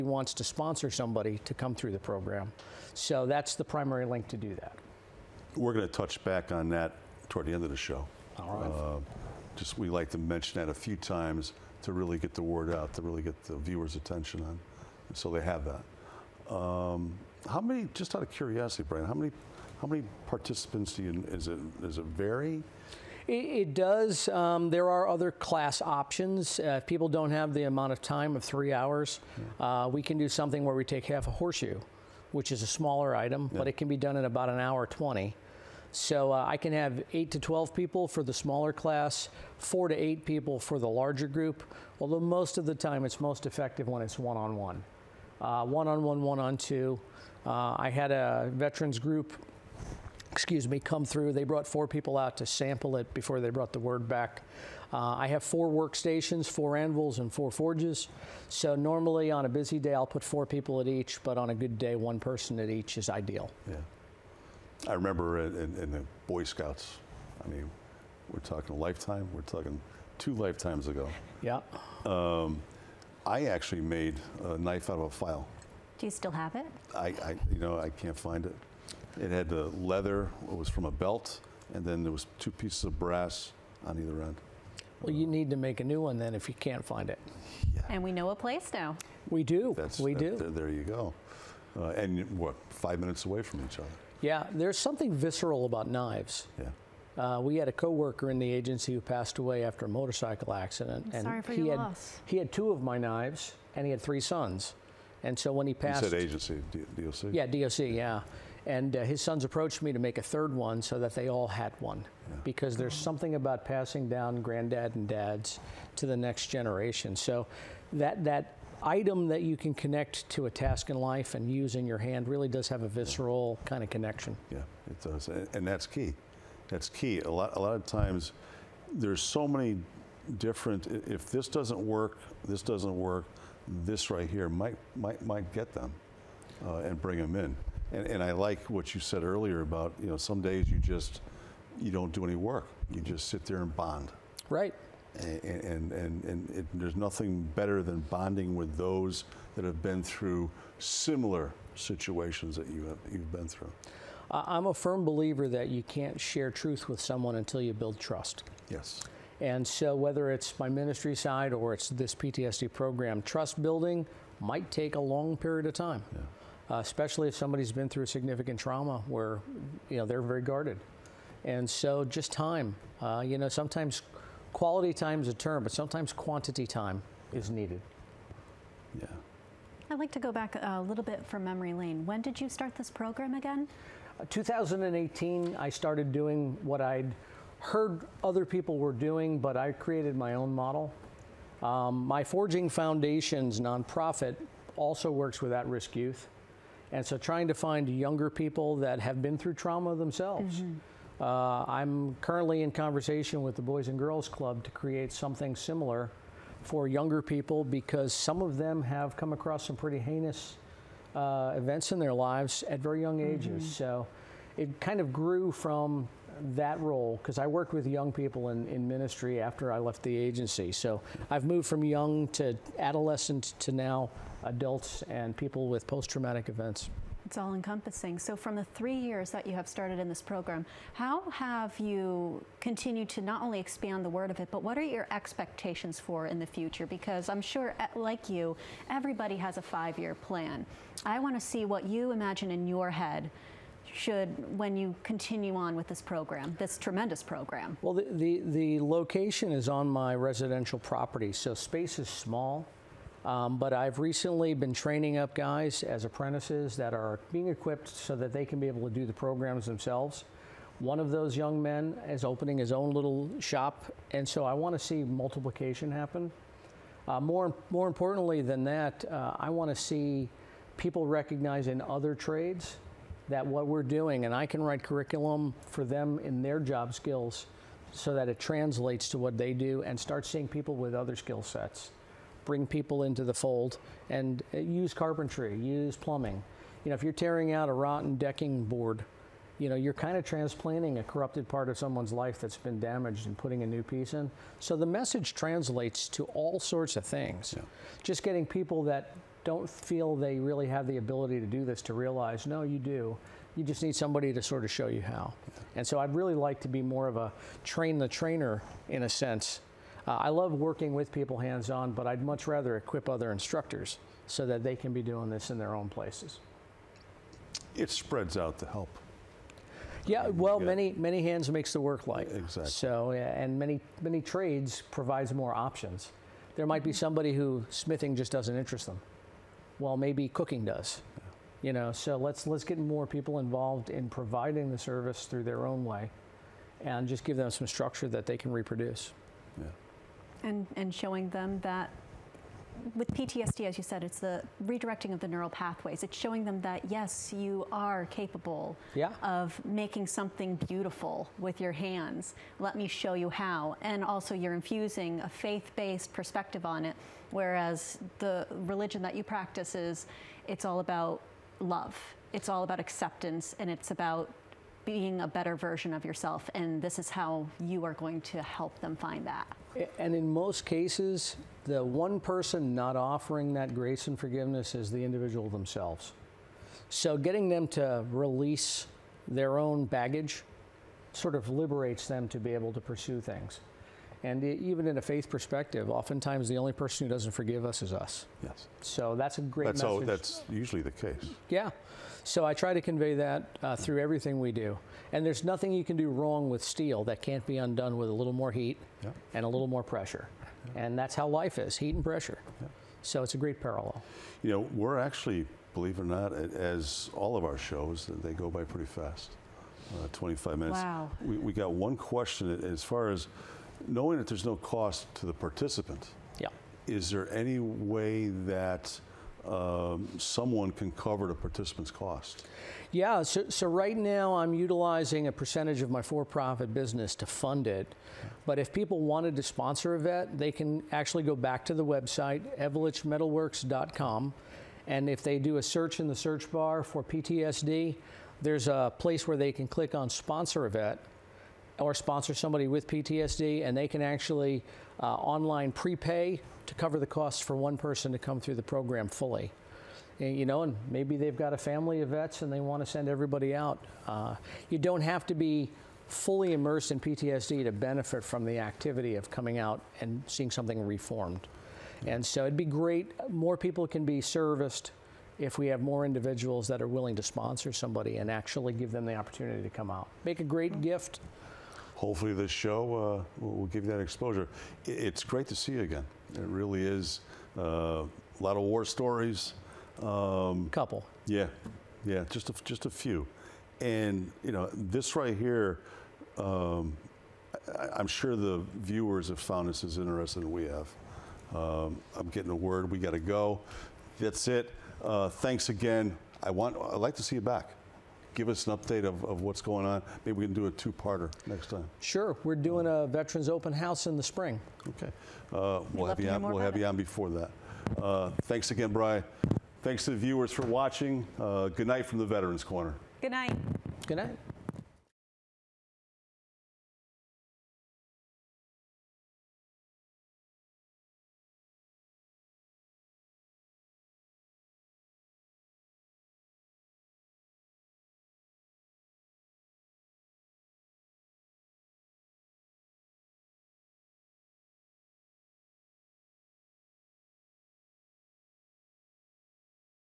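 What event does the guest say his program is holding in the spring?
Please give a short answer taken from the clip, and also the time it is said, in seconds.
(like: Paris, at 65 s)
Veterans Open House, at 503 s.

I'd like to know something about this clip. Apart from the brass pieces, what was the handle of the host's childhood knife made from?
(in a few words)
A belt.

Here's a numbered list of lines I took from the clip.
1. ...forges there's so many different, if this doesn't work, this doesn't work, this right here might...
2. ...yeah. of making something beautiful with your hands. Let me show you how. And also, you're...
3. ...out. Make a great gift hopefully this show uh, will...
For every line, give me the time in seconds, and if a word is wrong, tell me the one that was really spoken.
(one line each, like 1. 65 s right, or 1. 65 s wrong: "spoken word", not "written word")
1. 127 s wrong: "times", not "forges"
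2. 348 s right
3. 469 s right.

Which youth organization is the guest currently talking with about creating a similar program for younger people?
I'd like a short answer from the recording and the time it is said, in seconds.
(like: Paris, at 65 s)
Boys and Girls Club, at 203 s.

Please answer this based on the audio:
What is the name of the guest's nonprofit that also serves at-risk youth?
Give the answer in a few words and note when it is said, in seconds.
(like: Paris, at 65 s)
Forging Foundations, at 192 s.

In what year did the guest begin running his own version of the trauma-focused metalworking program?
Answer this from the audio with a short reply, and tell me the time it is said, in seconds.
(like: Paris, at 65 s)
2018, at 184 s.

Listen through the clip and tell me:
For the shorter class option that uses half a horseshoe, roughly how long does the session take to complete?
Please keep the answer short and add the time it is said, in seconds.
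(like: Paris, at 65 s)
About an hour 20, at 34 s.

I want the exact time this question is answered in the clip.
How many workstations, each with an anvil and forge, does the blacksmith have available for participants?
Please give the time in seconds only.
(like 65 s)
55 s.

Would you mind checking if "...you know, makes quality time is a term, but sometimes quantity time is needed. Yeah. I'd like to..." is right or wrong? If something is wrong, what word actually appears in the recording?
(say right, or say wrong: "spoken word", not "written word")
wrong: "sometimes", not "makes".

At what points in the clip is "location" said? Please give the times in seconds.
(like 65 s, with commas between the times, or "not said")
248 s.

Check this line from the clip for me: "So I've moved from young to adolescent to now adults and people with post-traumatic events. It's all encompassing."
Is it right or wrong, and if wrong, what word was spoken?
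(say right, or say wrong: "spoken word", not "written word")
right.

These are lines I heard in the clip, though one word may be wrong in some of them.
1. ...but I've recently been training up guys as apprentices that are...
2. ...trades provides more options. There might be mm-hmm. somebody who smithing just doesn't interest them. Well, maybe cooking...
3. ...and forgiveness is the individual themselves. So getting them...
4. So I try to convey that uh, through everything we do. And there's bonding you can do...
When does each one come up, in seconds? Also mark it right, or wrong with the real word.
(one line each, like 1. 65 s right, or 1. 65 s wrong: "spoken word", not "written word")
1. 253 s right
2. 324 s right
3. 374 s right
4. 392 s wrong: "nothing", not "bonding".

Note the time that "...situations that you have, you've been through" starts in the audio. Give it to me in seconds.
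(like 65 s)
151 s.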